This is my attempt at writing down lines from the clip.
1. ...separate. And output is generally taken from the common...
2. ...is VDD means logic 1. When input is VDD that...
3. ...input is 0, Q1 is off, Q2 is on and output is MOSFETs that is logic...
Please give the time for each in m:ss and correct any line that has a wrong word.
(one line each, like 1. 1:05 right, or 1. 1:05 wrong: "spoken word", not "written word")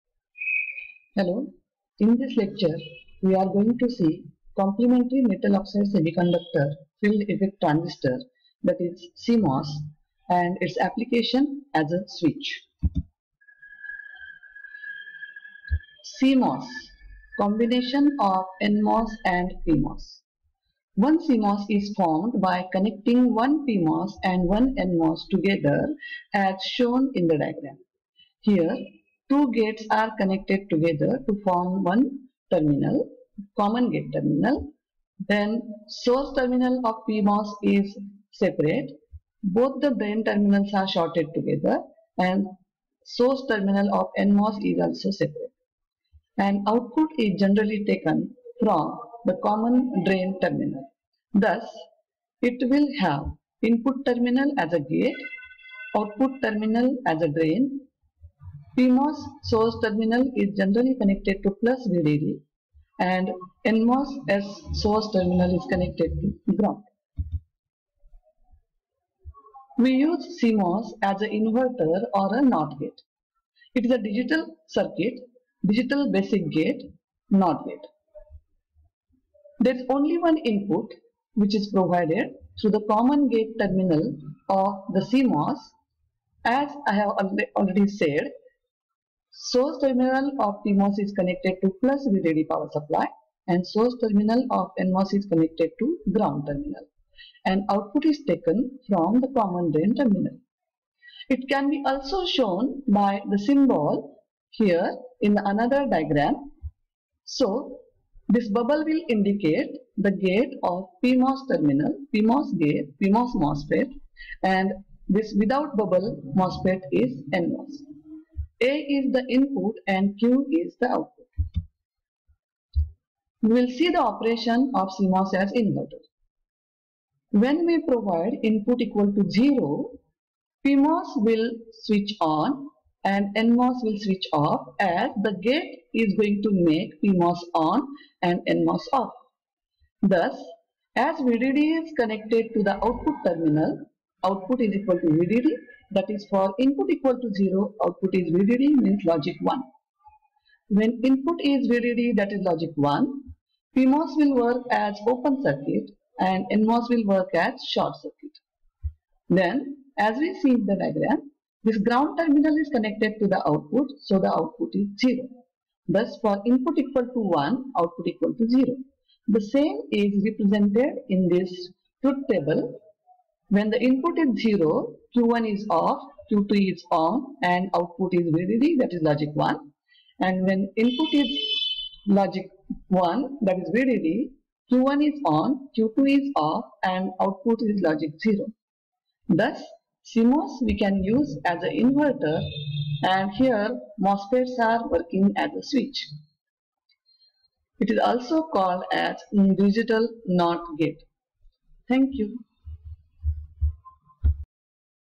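1. 0:45 right
2. 2:28 right
3. 2:53 wrong: "VDD", not "MOSFETs".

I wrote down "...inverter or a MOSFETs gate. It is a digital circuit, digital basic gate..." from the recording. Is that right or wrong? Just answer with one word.
wrong.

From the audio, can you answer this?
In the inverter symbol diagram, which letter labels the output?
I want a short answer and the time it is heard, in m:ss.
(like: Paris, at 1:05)
Q, at 2:00.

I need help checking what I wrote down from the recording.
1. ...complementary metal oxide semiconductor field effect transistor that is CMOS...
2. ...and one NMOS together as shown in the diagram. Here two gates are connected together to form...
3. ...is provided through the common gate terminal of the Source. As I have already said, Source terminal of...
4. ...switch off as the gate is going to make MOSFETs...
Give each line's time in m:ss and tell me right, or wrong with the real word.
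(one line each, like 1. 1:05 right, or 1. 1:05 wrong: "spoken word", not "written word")
1. 0:04 right
2. 0:24 right
3. 1:21 wrong: "CMOS", not "Source"
4. 2:13 wrong: "PMOS", not "MOSFETs".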